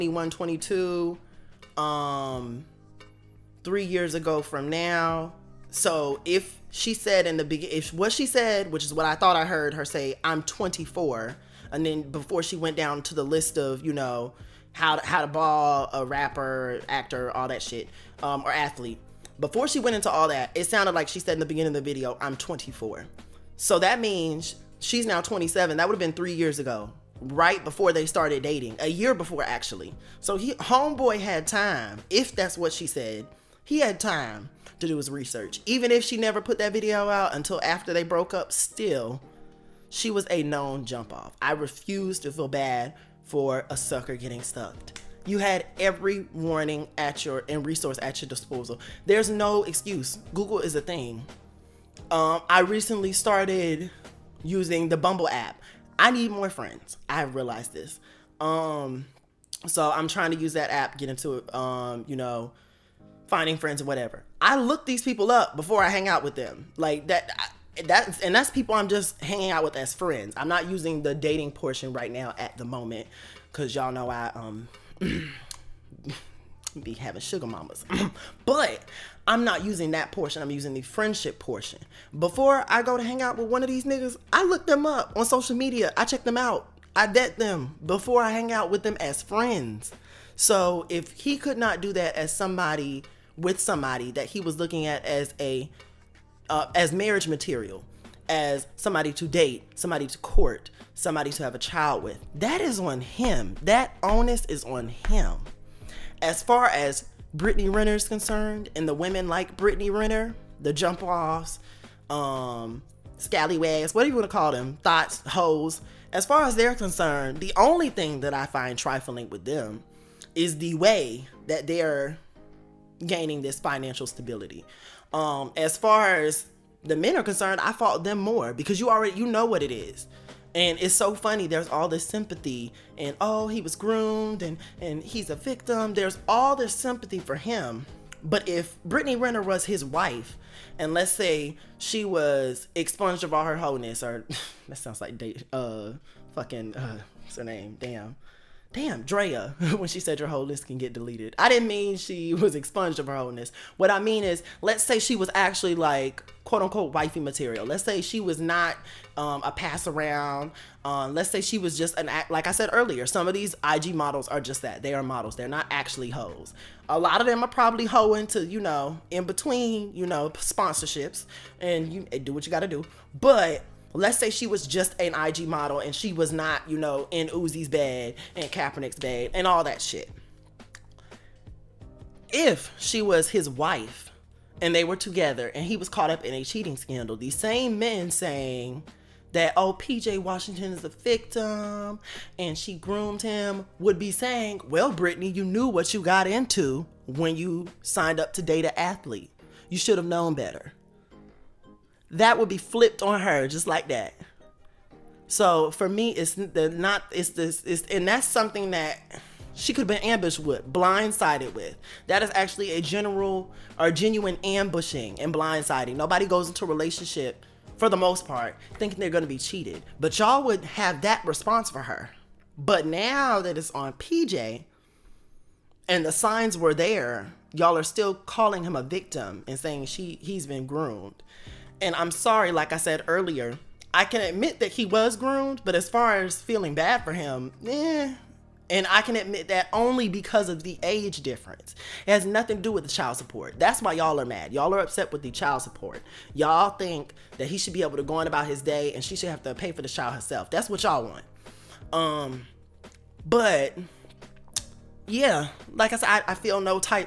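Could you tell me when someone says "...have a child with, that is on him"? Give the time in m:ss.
1:41.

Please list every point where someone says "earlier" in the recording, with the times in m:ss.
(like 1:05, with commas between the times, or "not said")
2:42, 3:53.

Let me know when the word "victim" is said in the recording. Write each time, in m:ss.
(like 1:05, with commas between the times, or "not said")
2:15, 3:10, 3:48.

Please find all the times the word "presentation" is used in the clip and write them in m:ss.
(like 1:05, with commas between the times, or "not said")
not said.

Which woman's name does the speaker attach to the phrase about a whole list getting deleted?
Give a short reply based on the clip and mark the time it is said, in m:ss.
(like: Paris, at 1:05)
Drea, at 2:29.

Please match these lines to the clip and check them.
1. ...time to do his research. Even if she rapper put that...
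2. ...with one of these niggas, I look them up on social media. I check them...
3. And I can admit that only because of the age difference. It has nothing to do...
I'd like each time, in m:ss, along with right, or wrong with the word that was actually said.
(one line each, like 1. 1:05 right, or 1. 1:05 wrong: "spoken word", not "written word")
1. 0:33 wrong: "never", not "rapper"
2. 1:23 right
3. 3:58 right.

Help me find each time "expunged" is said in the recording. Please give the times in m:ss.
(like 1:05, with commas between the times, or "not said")
2:22, 2:32.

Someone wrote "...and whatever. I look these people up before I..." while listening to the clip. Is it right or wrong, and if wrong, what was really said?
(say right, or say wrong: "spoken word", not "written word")
right.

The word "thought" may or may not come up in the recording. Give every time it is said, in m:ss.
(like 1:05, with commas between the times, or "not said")
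0:09, 1:54.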